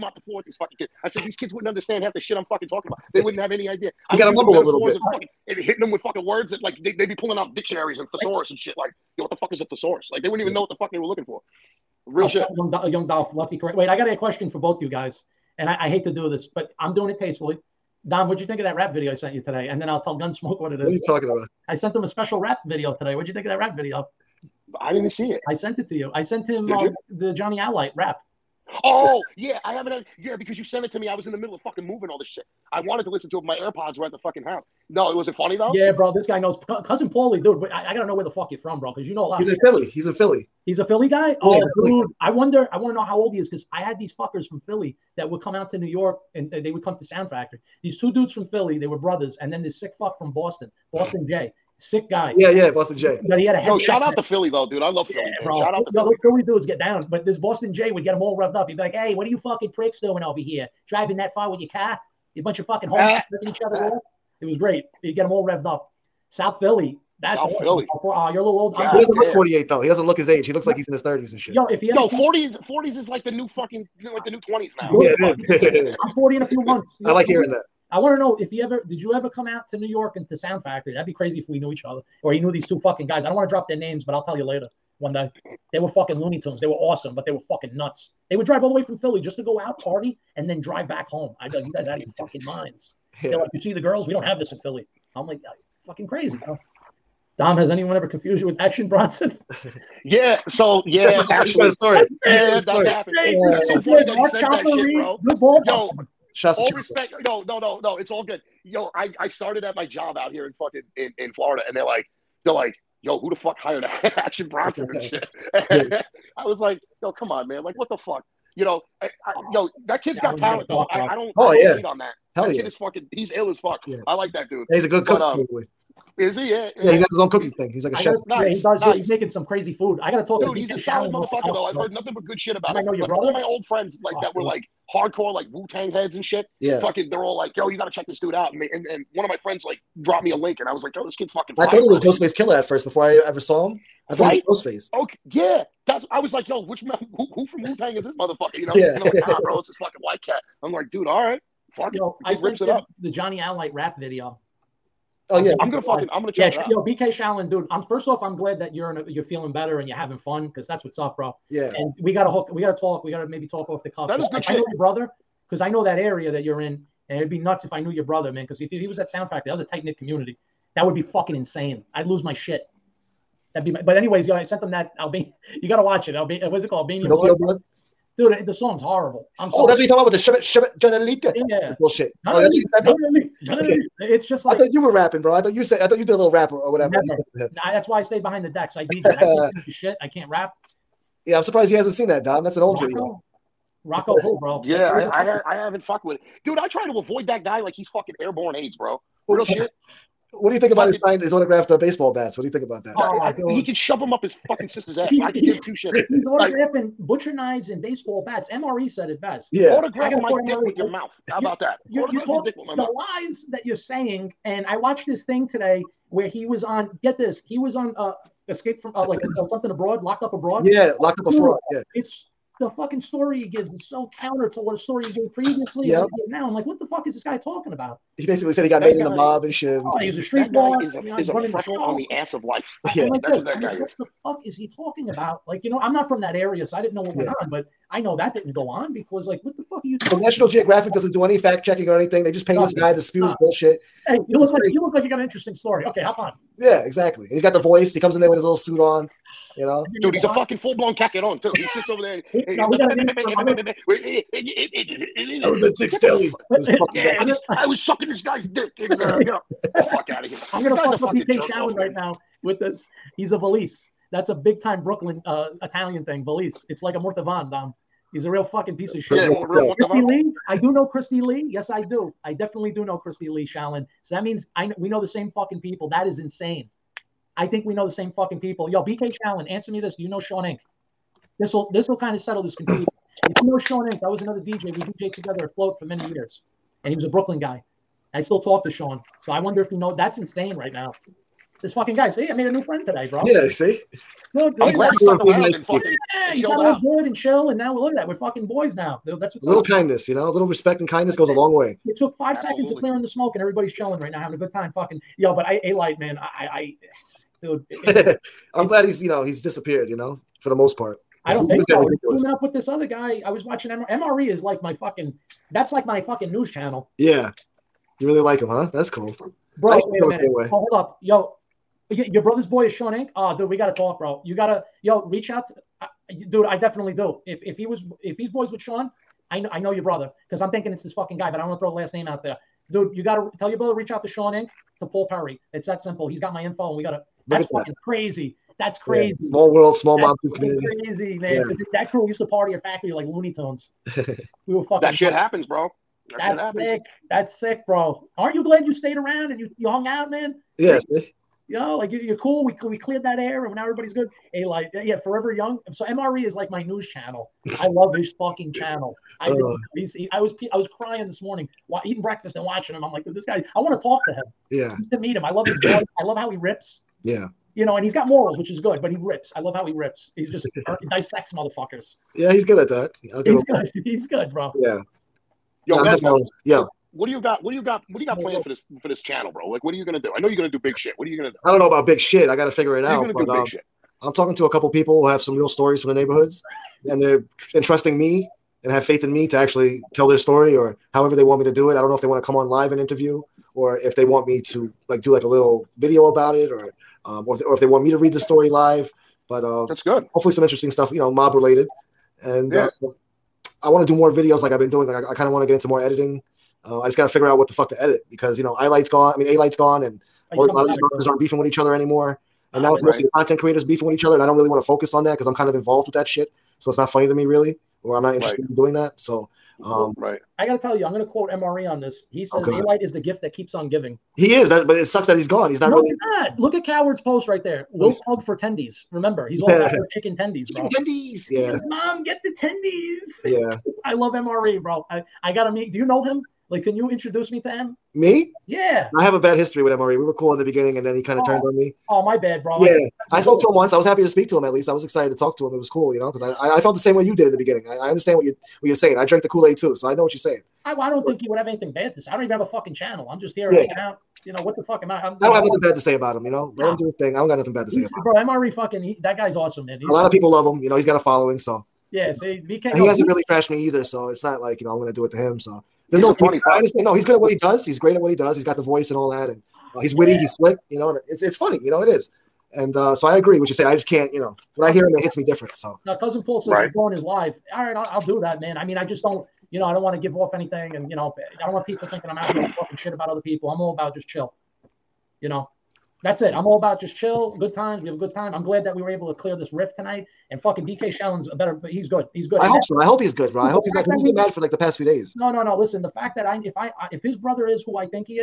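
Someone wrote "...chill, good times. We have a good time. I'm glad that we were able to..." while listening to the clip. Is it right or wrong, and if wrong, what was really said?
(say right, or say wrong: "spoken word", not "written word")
right.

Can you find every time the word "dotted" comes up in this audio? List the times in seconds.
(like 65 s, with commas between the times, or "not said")
not said.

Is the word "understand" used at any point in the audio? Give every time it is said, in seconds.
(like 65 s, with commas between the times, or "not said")
1 s, 447 s, 466 s.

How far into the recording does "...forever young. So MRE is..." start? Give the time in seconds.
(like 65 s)
355 s.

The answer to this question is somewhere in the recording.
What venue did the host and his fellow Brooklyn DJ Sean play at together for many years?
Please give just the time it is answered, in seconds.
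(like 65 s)
285 s.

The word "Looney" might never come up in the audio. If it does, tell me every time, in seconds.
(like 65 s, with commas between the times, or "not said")
86 s, 343 s.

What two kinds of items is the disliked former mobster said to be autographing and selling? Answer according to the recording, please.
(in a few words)
Butcher knives and baseball bats.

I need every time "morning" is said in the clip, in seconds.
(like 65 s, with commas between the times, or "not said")
361 s.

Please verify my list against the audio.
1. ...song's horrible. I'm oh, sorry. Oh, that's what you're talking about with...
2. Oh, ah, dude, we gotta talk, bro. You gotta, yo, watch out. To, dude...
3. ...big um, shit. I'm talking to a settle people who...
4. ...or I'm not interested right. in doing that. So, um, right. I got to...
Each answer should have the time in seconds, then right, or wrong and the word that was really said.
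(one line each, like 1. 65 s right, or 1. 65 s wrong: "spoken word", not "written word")
1. 178 s right
2. 323 s wrong: "reach", not "watch"
3. 383 s wrong: "couple", not "settle"
4. 417 s right.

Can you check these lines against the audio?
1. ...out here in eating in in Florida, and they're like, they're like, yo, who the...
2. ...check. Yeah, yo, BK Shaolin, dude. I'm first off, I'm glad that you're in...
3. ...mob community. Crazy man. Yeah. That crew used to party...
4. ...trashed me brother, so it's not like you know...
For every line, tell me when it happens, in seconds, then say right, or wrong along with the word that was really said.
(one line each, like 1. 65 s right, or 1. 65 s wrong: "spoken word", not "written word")
1. 110 s wrong: "fucking", not "eating"
2. 156 s right
3. 340 s right
4. 463 s wrong: "either", not "brother".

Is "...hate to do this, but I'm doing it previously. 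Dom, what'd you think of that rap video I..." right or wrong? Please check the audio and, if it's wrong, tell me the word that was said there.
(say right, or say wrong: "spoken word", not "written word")
wrong: "tastefully", not "previously".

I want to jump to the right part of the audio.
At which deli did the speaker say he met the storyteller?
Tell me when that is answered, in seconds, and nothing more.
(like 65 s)
255 s.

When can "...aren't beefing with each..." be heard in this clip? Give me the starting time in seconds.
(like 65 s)
411 s.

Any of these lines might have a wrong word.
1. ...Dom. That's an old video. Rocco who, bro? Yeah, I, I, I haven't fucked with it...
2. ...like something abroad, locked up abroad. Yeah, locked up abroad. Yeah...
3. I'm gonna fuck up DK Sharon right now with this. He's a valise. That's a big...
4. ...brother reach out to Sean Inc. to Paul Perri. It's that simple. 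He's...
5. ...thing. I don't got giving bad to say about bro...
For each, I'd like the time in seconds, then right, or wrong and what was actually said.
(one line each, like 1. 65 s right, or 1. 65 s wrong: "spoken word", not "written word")
1. 192 s right
2. 219 s right
3. 260 s right
4. 333 s right
5. 456 s wrong: "nothing", not "giving".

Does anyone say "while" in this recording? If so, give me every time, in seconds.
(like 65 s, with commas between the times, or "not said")
361 s.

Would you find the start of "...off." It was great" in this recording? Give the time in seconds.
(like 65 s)
63 s.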